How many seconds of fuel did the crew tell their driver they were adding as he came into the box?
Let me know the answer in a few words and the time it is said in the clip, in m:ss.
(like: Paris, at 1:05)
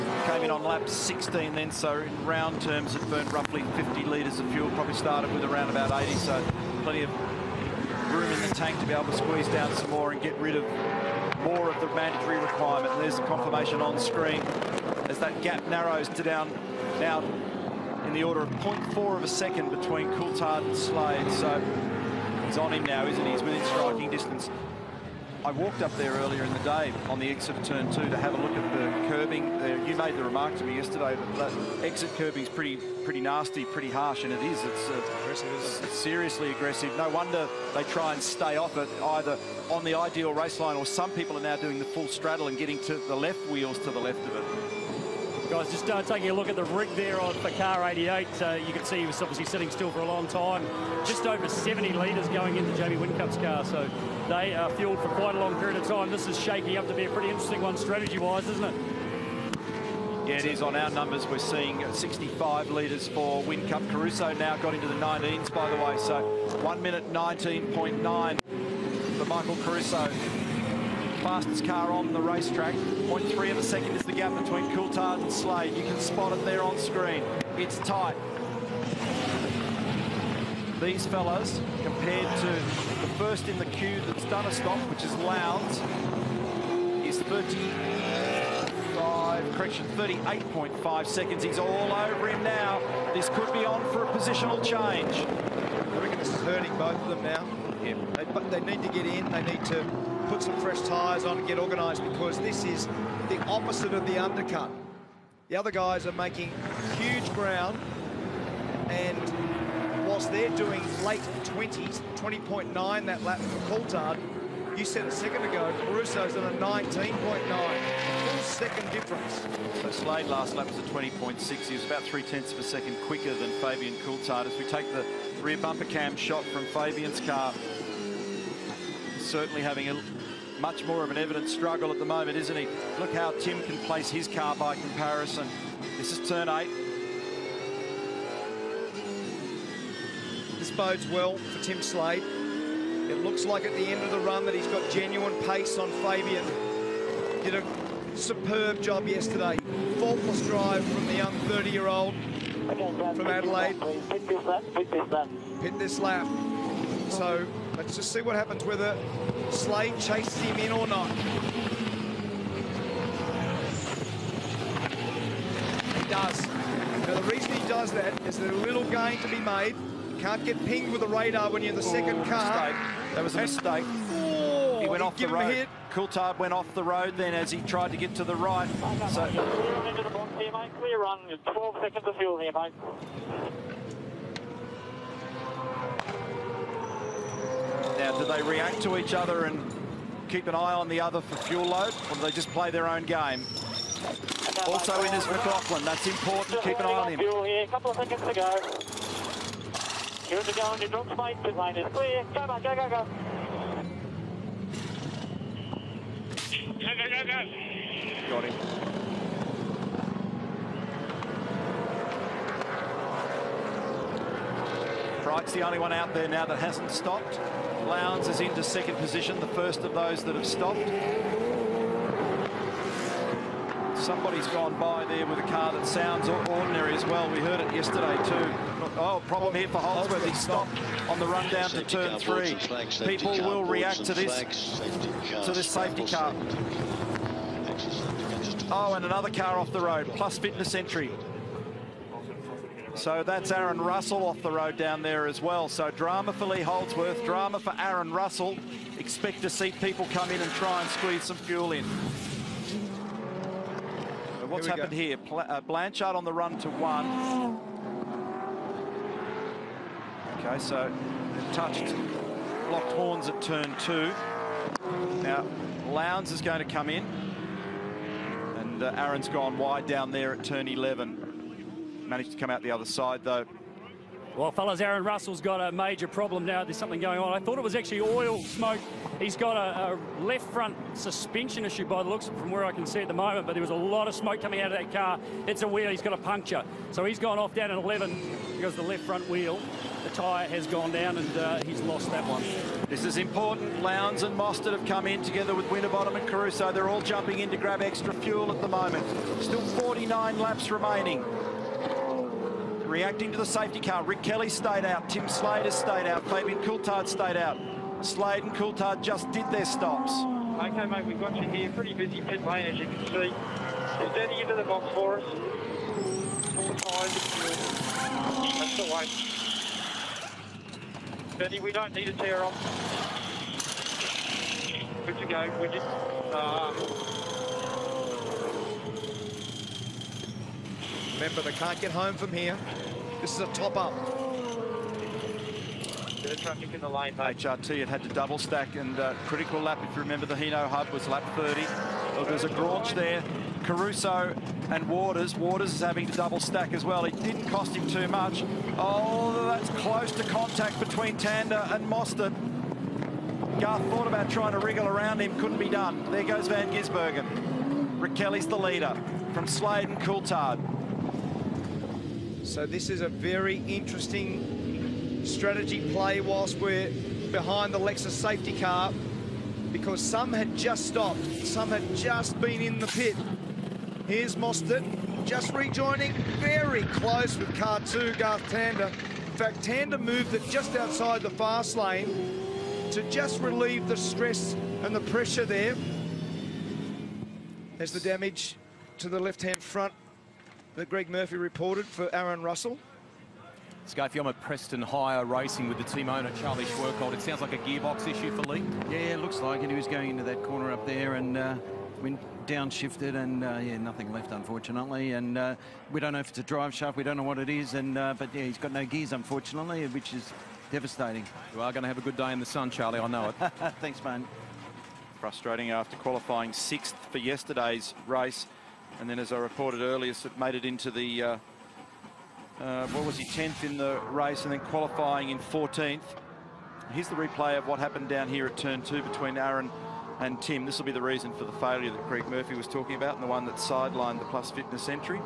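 12, at 3:01.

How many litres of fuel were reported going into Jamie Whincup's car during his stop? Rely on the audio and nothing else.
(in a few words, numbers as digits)
Over 70.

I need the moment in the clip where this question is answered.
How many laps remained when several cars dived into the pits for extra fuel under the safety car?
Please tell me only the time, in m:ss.
4:59.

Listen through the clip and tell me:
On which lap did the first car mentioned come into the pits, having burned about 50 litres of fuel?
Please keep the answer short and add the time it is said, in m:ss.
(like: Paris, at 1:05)
16, at 0:00.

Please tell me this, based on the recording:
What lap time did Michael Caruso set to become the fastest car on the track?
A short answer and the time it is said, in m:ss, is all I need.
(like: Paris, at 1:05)
1:19.9, at 1:06.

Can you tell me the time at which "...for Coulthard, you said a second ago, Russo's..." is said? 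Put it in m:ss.
1:53.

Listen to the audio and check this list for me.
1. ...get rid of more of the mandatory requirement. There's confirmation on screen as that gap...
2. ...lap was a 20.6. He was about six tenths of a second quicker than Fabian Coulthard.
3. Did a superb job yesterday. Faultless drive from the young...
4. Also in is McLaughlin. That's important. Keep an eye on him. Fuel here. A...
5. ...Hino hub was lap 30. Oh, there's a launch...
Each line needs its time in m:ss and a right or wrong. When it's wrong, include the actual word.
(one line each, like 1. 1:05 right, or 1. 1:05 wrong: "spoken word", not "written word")
1. 0:10 right
2. 2:00 wrong: "three", not "six"
3. 2:27 right
4. 3:14 right
5. 5:40 right.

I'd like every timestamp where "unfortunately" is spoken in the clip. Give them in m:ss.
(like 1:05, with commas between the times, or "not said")
6:44, 6:49.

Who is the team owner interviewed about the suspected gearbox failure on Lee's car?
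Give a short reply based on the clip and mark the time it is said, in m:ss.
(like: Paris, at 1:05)
Charlie Schwerkolt, at 6:36.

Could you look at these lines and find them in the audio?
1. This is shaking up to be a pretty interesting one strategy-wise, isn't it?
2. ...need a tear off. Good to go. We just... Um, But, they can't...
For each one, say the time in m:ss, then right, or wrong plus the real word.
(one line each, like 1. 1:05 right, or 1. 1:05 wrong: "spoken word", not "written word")
1. 0:56 right
2. 5:21 wrong: "Remember", not "But".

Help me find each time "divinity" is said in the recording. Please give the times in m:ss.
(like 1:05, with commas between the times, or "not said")
not said.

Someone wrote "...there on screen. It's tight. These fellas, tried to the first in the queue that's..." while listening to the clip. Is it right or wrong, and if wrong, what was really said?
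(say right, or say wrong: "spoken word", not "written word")
wrong: "compared", not "tried".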